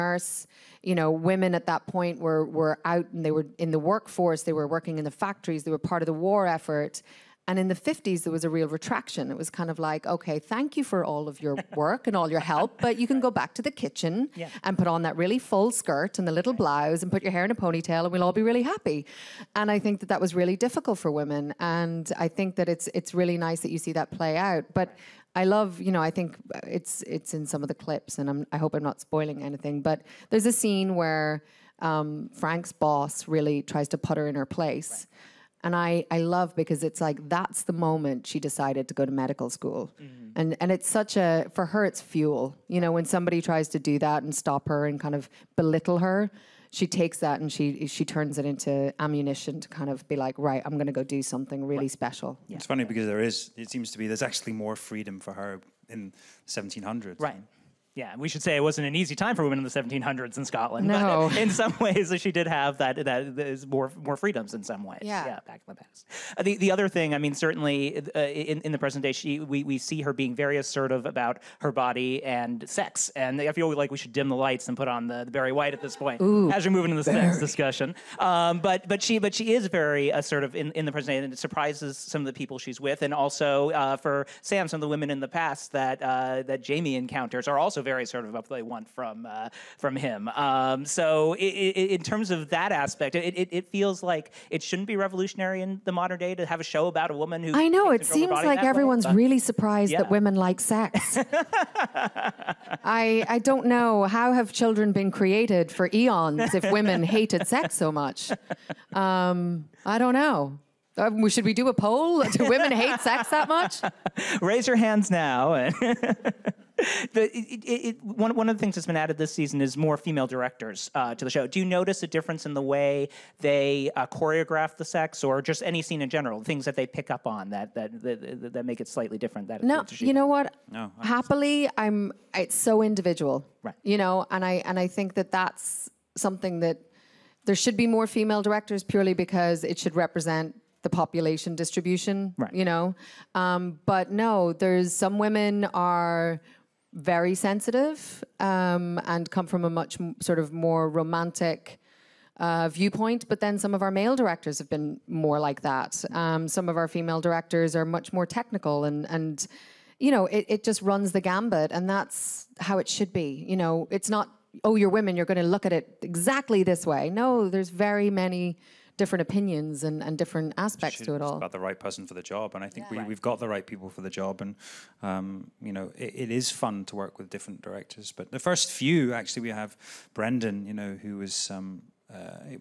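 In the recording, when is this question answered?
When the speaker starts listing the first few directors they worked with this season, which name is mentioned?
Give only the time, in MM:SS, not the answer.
03:00.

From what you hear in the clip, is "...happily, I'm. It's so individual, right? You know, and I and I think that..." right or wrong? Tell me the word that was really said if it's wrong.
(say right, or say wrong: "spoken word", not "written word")
right.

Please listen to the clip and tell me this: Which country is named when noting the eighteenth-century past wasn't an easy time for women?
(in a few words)
Scotland.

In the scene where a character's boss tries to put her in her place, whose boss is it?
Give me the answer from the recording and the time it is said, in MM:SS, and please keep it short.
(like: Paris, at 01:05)
Frank, at 00:32.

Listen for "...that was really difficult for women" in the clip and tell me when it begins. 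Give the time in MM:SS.
00:20.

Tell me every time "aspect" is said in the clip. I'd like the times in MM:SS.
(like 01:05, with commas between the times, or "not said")
01:32, 02:50.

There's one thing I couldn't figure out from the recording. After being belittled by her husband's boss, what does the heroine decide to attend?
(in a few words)
medical school.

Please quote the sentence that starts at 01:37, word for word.
I know it seems like everyone's way, really surprised yeah.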